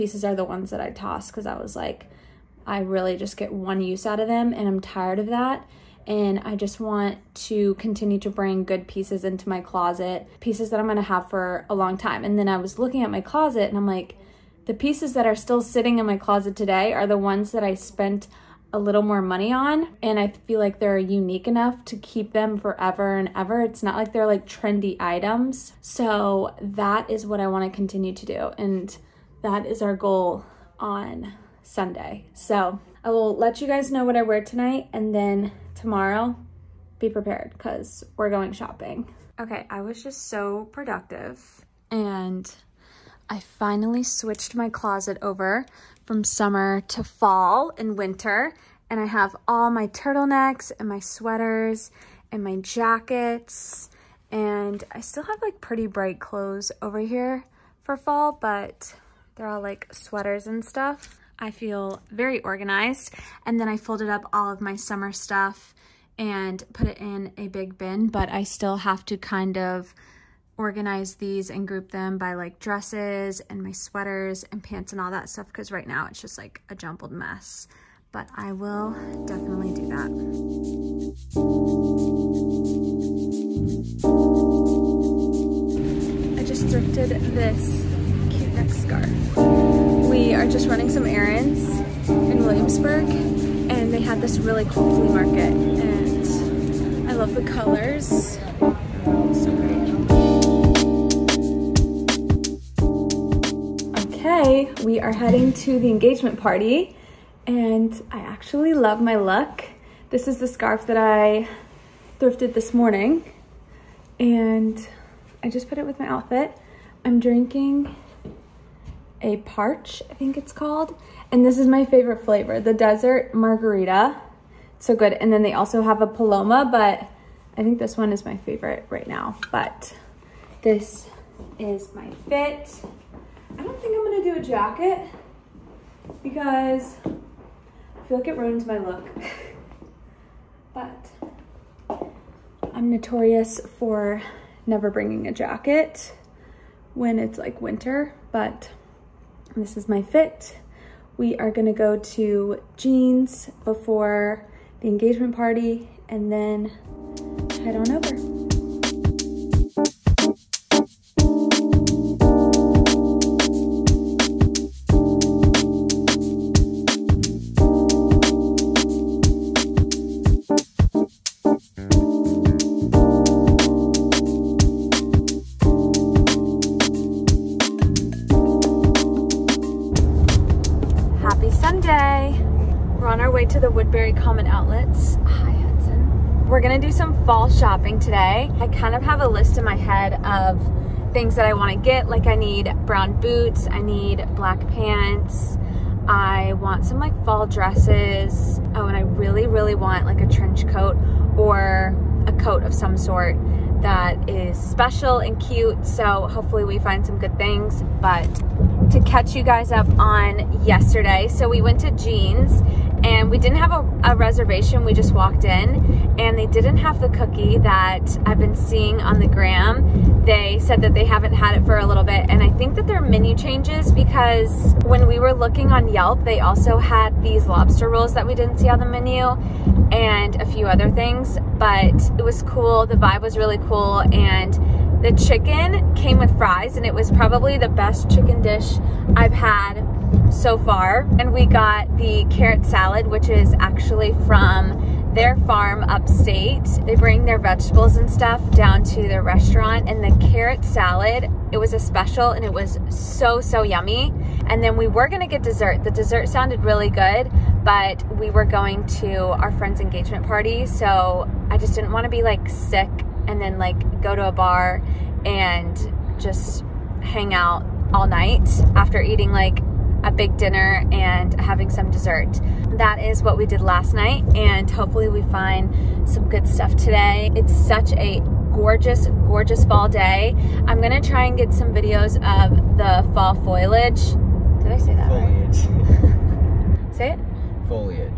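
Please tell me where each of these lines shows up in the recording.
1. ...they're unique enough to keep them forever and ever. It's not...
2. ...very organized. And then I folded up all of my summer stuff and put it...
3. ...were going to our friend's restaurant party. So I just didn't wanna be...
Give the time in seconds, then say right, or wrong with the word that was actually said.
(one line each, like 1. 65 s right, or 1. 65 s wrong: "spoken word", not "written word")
1. 20 s right
2. 62 s right
3. 258 s wrong: "engagement", not "restaurant".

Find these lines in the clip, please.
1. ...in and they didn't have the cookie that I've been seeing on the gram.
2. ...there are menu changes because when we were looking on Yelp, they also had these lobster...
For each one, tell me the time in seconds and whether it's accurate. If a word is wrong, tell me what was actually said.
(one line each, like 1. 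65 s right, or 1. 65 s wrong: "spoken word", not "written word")
1. 215 s right
2. 222 s right.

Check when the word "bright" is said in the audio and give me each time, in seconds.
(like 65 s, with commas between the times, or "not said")
55 s.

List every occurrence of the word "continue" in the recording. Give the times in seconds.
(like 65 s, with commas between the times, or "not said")
7 s, 27 s.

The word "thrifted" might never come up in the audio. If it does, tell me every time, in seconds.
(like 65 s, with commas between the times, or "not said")
86 s, 112 s.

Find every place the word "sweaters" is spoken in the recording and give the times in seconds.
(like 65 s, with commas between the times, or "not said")
50 s, 59 s, 73 s.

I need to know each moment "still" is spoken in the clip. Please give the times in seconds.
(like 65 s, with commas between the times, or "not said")
15 s, 55 s, 68 s.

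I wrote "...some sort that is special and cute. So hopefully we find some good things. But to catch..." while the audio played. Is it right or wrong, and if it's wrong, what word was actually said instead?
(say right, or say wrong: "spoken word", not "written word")
right.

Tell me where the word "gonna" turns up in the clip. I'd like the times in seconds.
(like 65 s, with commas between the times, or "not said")
10 s, 134 s, 151 s, 186 s, 255 s, 280 s.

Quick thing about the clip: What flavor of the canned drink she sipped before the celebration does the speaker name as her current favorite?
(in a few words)
Desert margarita.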